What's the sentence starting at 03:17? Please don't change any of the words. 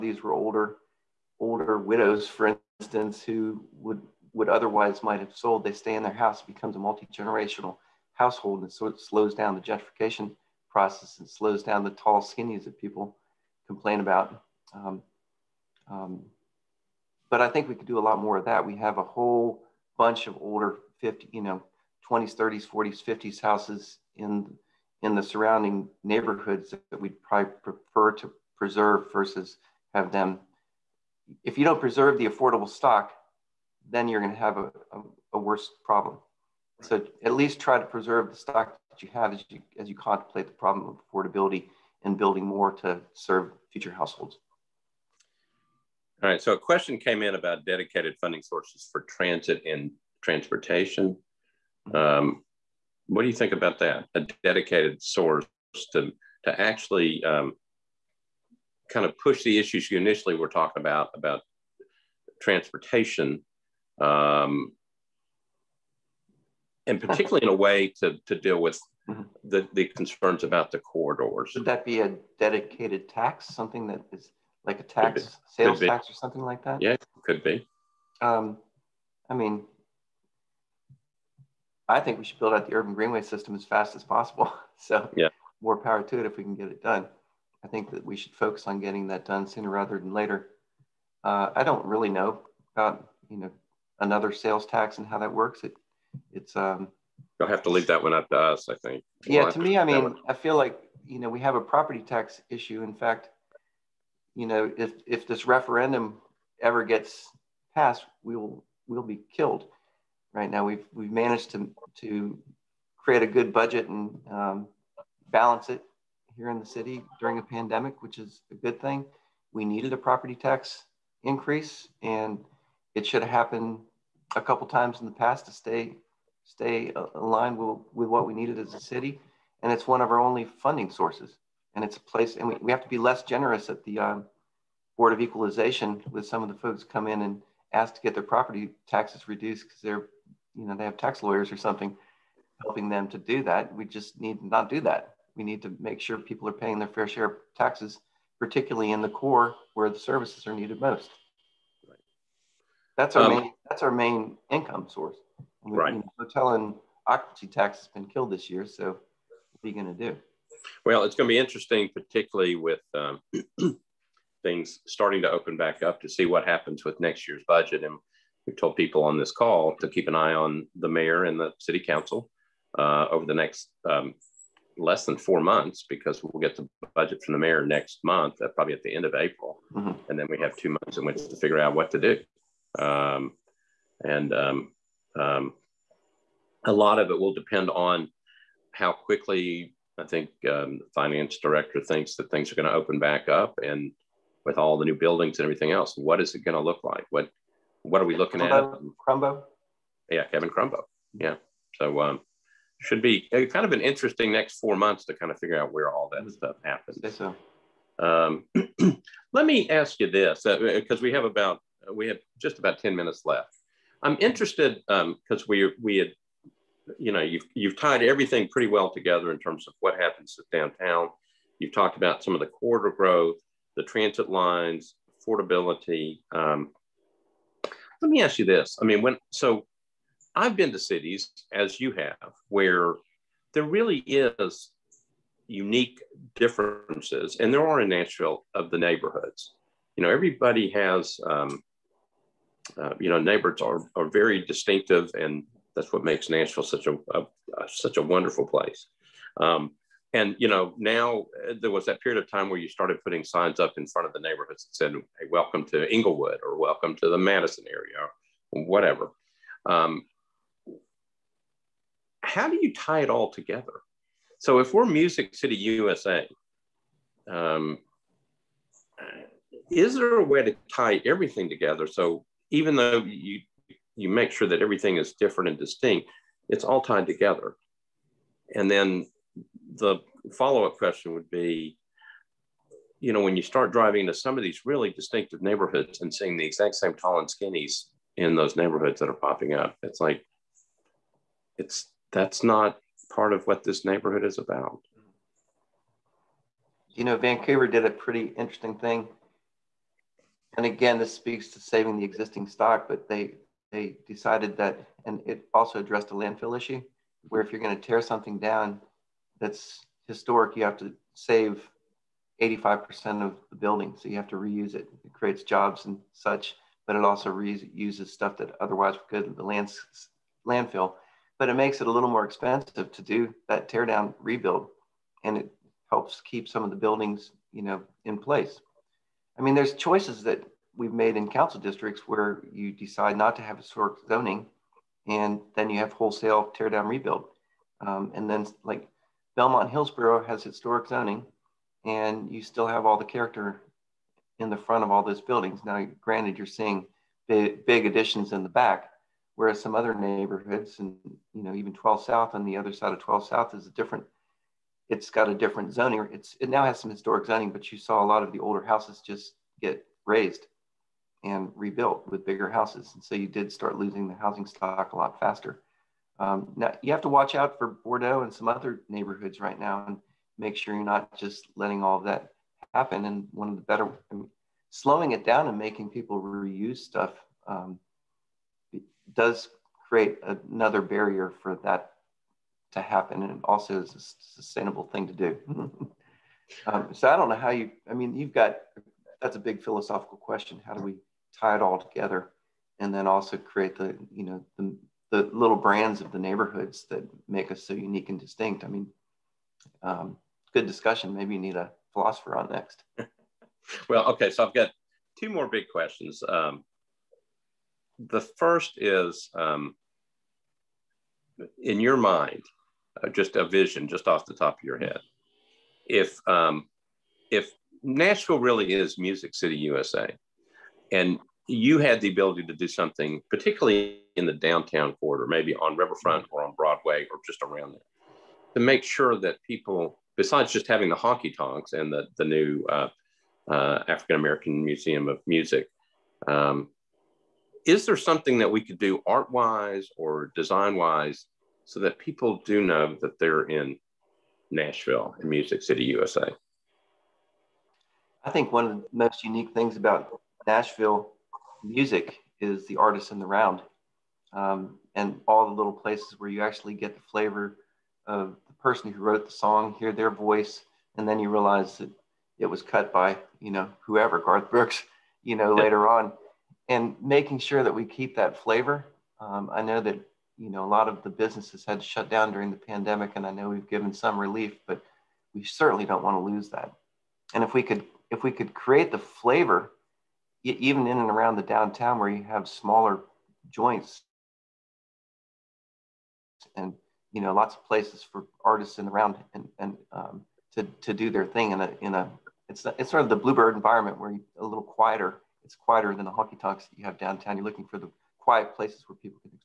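What what are we looking Crumbo, at?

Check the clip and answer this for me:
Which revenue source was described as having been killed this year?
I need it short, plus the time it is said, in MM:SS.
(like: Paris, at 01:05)
hotel and occupancy tax, at 02:36.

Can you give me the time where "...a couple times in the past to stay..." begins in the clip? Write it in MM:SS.
02:04.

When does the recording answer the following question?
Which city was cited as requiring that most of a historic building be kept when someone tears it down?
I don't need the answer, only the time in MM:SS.
04:57.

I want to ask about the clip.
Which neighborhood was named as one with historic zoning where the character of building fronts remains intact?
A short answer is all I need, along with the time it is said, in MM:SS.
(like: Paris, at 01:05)
Belmont Hillsboro, at 05:39.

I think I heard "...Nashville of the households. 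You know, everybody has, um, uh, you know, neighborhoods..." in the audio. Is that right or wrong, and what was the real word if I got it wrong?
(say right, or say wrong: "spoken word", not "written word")
wrong: "neighborhoods", not "households".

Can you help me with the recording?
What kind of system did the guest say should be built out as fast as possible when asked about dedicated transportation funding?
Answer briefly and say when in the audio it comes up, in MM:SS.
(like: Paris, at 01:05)
urban greenway system, at 01:22.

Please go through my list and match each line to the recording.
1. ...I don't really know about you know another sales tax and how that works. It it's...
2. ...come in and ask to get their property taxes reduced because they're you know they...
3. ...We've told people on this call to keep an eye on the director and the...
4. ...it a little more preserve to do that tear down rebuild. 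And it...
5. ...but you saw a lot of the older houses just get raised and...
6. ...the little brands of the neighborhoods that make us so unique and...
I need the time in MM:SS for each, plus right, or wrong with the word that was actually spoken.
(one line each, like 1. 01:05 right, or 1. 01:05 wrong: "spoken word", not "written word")
1. 01:31 right
2. 02:16 right
3. 02:48 wrong: "mayor", not "director"
4. 05:21 wrong: "expensive", not "preserve"
5. 05:57 right
6. 06:35 right.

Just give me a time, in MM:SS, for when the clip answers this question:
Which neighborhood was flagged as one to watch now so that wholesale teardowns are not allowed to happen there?
06:07.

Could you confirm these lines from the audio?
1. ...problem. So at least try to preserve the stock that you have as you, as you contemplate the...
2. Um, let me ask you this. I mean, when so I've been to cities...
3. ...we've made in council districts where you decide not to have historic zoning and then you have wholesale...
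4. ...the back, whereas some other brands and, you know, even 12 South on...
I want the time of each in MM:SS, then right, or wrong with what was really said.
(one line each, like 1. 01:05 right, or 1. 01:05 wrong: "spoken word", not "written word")
1. 00:35 right
2. 03:46 right
3. 05:30 right
4. 05:48 wrong: "neighborhoods", not "brands".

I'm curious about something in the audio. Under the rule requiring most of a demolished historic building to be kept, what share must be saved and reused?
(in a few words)
85%.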